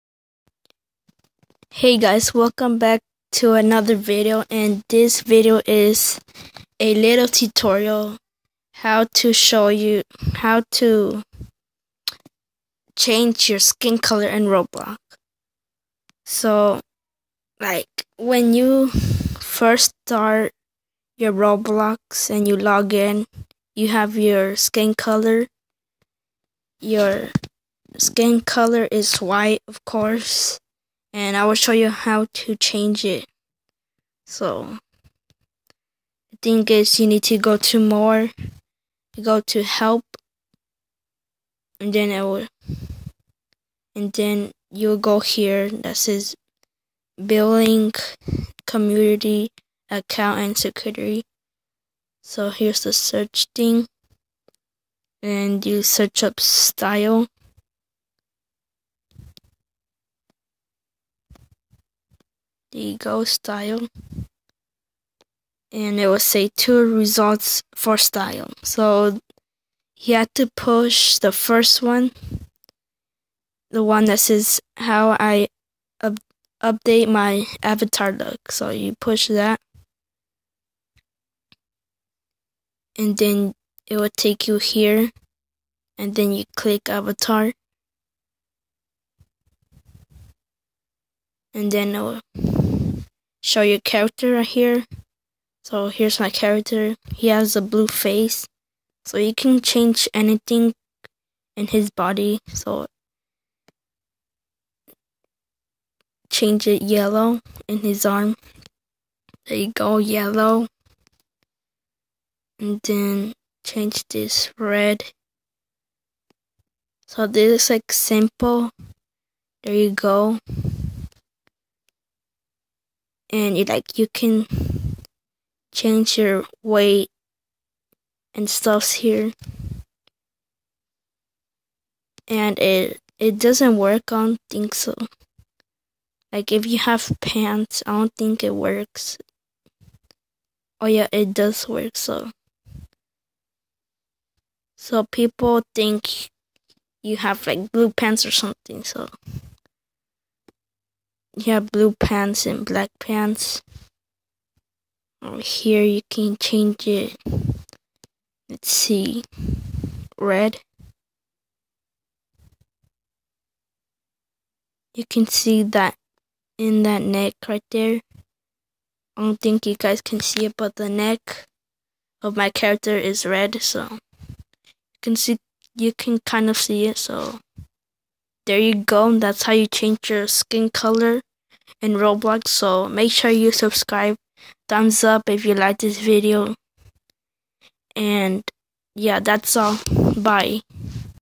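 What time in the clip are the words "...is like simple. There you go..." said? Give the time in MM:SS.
01:57.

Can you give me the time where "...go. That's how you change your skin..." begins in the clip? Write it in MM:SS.
02:58.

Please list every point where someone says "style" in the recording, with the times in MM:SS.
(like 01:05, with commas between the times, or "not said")
00:56, 01:03, 01:07.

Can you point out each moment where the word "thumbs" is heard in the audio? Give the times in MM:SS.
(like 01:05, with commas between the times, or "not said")
03:04.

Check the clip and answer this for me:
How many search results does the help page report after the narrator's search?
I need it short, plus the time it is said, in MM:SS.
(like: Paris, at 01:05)
2, at 01:06.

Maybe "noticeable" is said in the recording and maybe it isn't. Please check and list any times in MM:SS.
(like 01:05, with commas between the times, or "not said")
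not said.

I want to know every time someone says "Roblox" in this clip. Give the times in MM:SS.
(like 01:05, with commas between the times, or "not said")
00:14, 00:21, 03:01.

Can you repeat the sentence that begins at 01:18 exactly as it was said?
So you push that, and then it will take you here, and then you click avatar.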